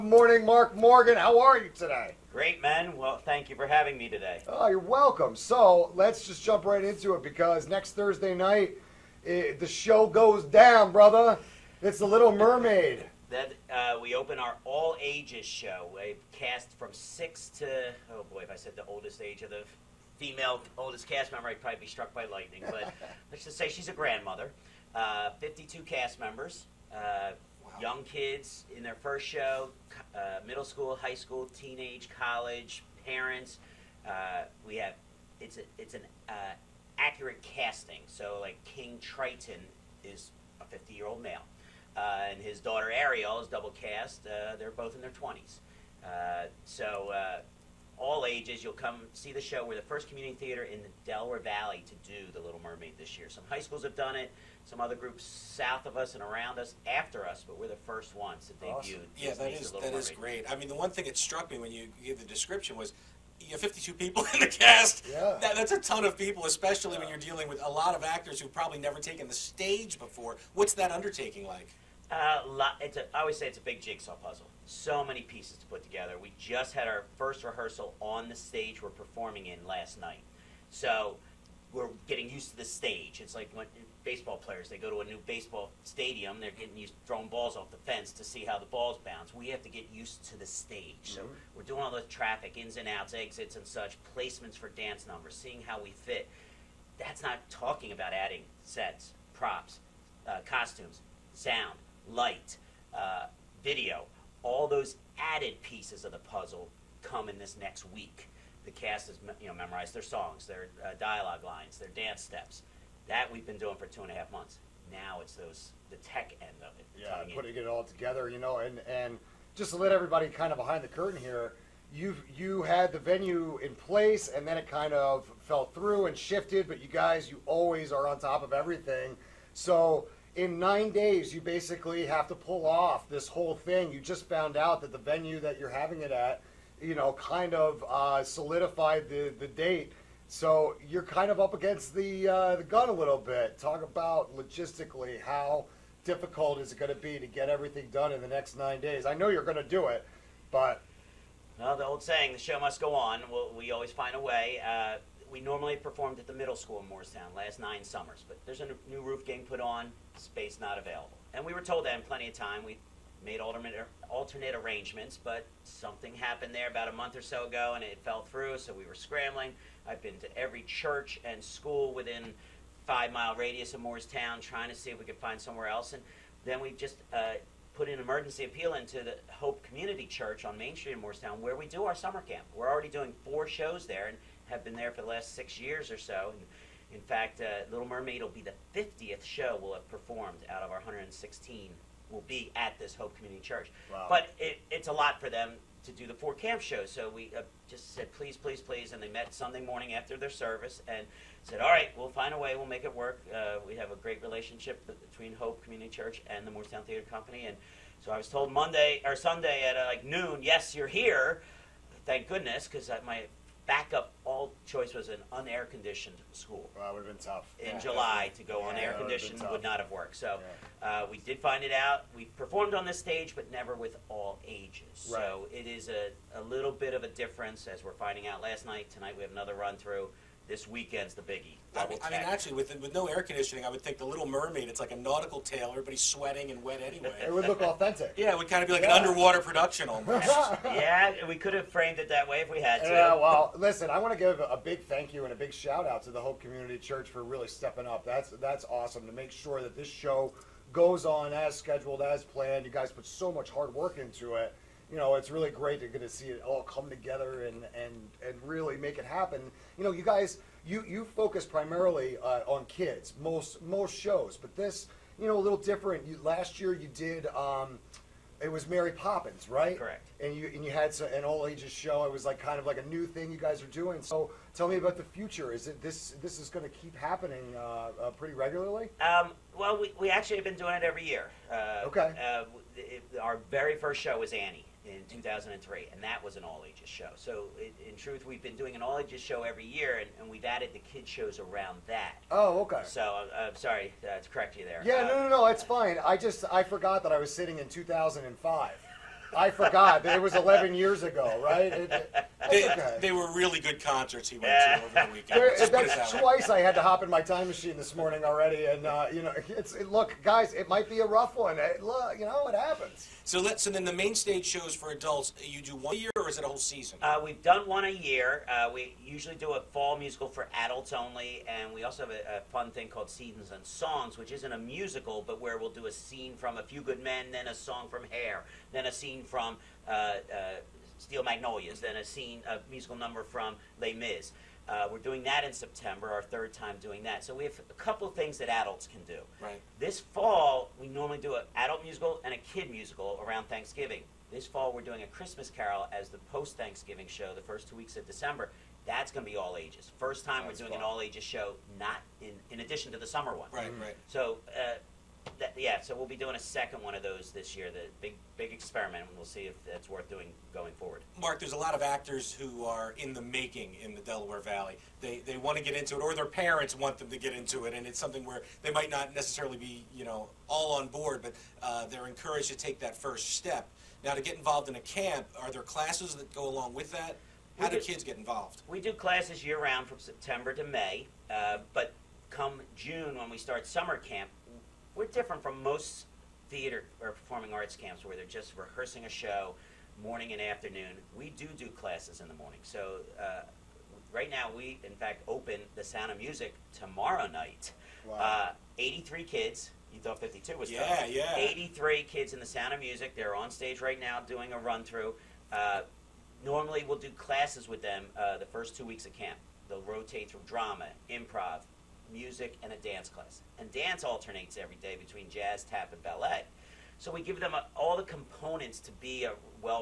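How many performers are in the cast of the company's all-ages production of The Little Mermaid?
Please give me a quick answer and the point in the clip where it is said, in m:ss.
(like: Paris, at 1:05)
52, at 0:25.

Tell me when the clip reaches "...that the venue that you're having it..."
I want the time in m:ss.
2:14.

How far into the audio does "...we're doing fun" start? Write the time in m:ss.
5:50.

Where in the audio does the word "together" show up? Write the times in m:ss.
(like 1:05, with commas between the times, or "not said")
1:15, 1:57, 4:16.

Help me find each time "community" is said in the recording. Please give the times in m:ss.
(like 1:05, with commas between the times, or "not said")
0:50, 2:59, 3:13, 3:25, 4:06.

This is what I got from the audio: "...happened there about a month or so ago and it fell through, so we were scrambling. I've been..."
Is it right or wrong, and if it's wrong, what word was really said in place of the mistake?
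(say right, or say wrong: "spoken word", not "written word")
right.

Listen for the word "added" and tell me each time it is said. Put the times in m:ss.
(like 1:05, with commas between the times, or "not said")
1:45, 4:50.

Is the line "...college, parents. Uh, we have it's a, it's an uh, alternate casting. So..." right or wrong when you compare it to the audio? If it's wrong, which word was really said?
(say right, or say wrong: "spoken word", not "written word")
wrong: "accurate", not "alternate".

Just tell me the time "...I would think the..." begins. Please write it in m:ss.
3:53.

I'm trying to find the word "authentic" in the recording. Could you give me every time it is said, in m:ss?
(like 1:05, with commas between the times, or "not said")
3:57.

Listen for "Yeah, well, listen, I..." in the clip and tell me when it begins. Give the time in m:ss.
4:02.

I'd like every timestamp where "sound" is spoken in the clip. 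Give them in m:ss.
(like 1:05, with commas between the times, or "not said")
1:41, 6:35, 6:42.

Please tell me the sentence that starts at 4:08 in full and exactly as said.
That's that's awesome to make sure that this show goes on as scheduled, as planned.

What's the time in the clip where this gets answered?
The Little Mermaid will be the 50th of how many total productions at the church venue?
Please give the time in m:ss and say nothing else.
3:10.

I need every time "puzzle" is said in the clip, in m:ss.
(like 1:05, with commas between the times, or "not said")
1:14, 1:46.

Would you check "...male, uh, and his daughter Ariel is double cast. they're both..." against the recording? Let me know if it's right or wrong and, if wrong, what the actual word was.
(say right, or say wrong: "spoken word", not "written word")
right.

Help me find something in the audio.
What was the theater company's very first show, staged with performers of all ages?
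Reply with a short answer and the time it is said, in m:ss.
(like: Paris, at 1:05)
Annie, at 4:44.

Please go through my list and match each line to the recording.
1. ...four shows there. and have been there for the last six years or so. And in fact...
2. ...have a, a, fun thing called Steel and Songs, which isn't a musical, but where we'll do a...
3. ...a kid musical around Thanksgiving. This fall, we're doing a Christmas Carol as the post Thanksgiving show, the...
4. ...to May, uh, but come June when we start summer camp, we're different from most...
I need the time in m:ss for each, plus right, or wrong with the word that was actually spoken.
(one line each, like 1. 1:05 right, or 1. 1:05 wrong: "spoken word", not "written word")
1. 3:03 right
2. 5:22 wrong: "Seasons", not "Steel"
3. 5:42 right
4. 6:20 right.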